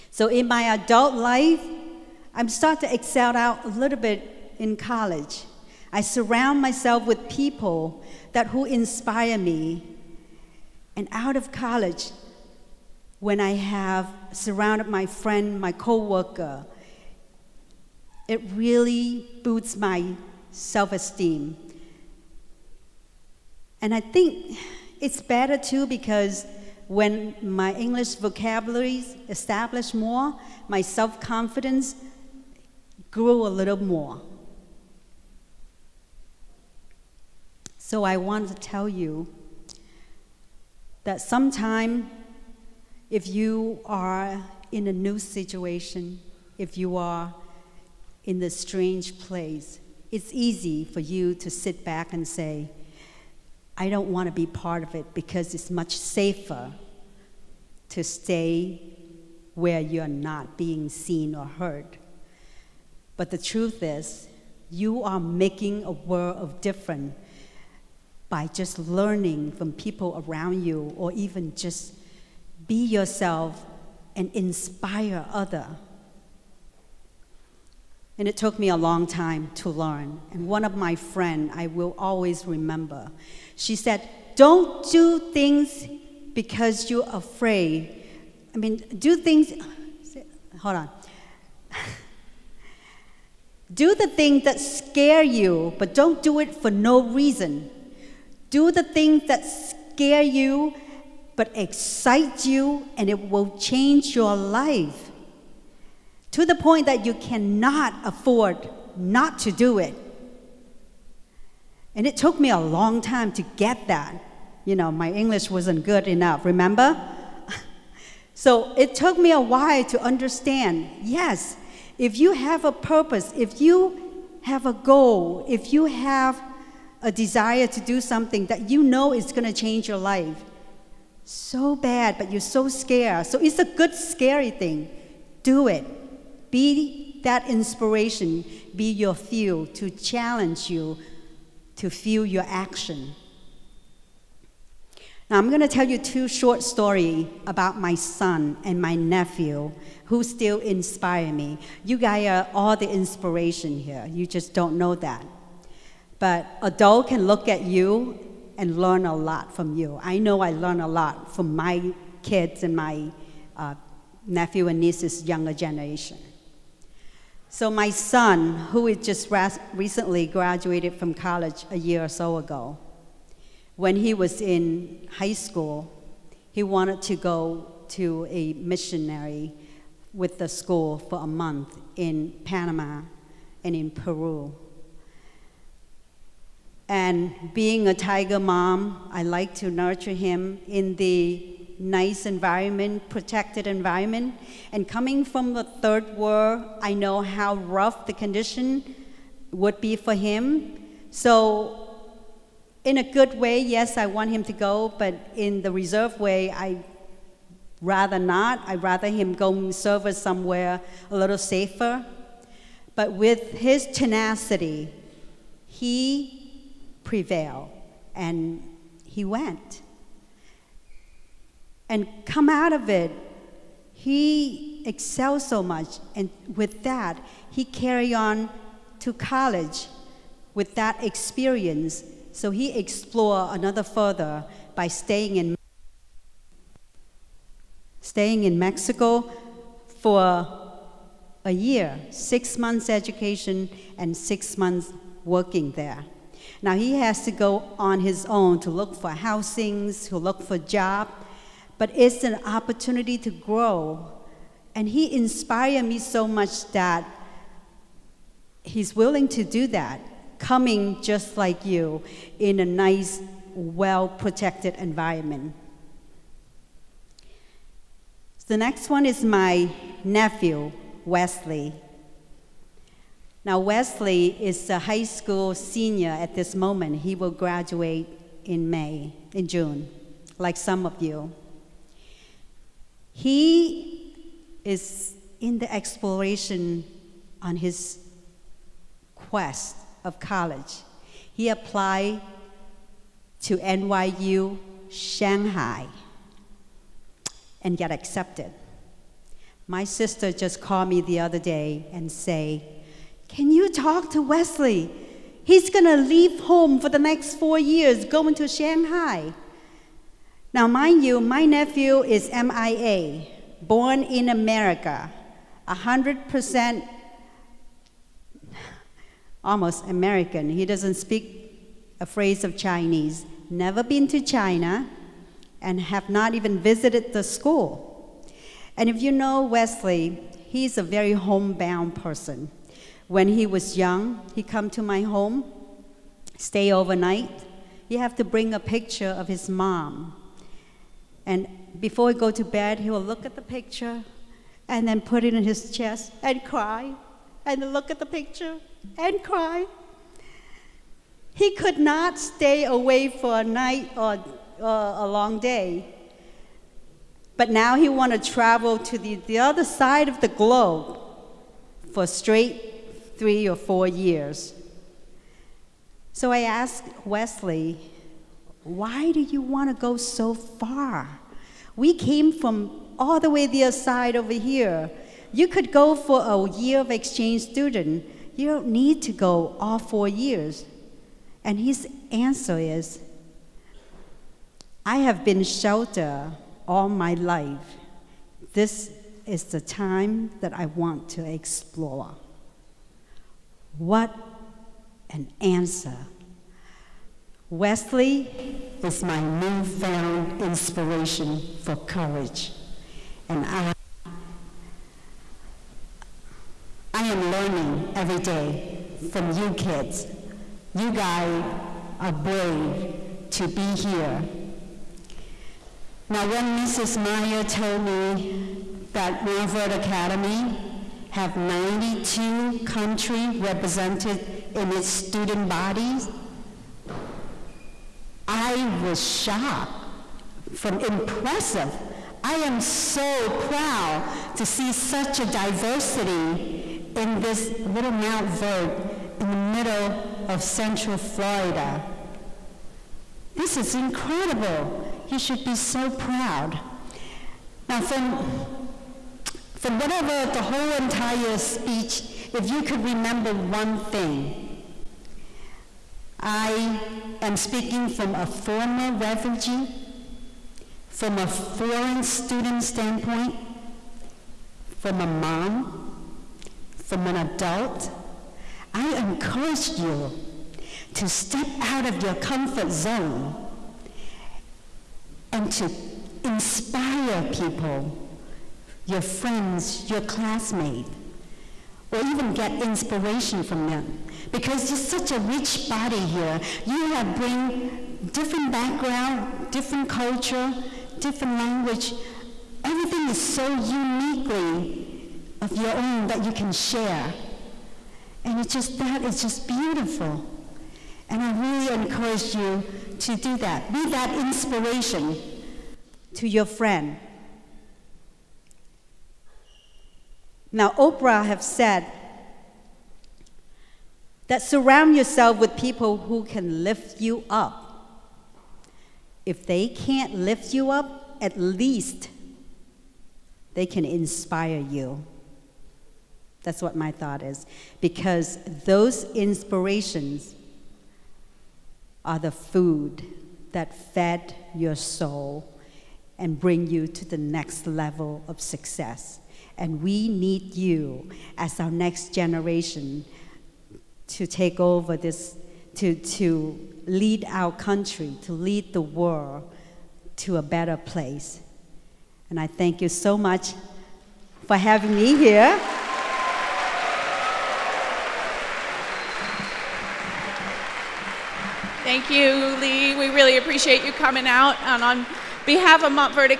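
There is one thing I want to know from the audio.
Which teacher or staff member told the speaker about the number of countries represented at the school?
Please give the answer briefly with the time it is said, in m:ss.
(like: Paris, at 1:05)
Mrs. Meyer, at 6:56.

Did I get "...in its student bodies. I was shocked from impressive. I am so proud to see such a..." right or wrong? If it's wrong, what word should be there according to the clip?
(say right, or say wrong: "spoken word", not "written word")
right.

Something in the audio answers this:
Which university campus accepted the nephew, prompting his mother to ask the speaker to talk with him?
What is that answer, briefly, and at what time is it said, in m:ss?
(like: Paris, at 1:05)
NYU Shanghai, at 4:53.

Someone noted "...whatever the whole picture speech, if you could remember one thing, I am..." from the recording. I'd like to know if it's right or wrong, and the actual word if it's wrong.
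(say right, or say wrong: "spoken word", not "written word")
wrong: "entire", not "picture".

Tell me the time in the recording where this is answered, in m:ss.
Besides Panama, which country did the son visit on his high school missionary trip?
3:03.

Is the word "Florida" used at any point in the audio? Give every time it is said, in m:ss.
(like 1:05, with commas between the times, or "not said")
7:20.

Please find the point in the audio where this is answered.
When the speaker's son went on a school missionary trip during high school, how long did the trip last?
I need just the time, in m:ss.
3:01.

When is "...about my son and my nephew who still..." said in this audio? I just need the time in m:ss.
2:27.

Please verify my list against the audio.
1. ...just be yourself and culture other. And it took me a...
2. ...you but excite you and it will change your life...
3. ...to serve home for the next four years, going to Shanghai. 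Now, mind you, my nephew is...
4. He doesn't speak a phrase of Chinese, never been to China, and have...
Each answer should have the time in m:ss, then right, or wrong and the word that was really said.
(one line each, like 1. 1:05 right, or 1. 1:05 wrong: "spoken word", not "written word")
1. 1:11 wrong: "inspire", not "culture"
2. 1:40 right
3. 5:05 wrong: "leave", not "serve"
4. 5:20 right.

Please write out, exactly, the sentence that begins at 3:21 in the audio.
So in a good way, yes, I want him to go, but in the reserve way, I rather not.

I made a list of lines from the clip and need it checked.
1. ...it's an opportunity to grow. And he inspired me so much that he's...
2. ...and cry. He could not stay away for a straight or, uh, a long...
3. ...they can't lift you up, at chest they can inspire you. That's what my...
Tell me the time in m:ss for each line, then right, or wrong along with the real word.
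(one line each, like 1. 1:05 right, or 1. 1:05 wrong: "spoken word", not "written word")
1. 4:11 right
2. 5:48 wrong: "night", not "straight"
3. 8:39 wrong: "least", not "chest".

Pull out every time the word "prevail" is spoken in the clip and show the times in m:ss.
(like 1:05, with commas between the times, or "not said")
3:37.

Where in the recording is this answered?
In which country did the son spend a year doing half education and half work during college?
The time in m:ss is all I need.
3:58.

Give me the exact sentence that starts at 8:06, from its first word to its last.
You have bring different background, different culture, different language.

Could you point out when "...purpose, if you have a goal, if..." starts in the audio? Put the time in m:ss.
2:02.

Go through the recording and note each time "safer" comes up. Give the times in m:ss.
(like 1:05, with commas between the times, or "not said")
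0:55, 3:31.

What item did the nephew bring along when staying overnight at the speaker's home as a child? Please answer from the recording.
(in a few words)
a picture of his mom.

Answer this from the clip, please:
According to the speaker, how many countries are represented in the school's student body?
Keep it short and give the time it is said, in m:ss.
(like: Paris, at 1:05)
92, at 7:01.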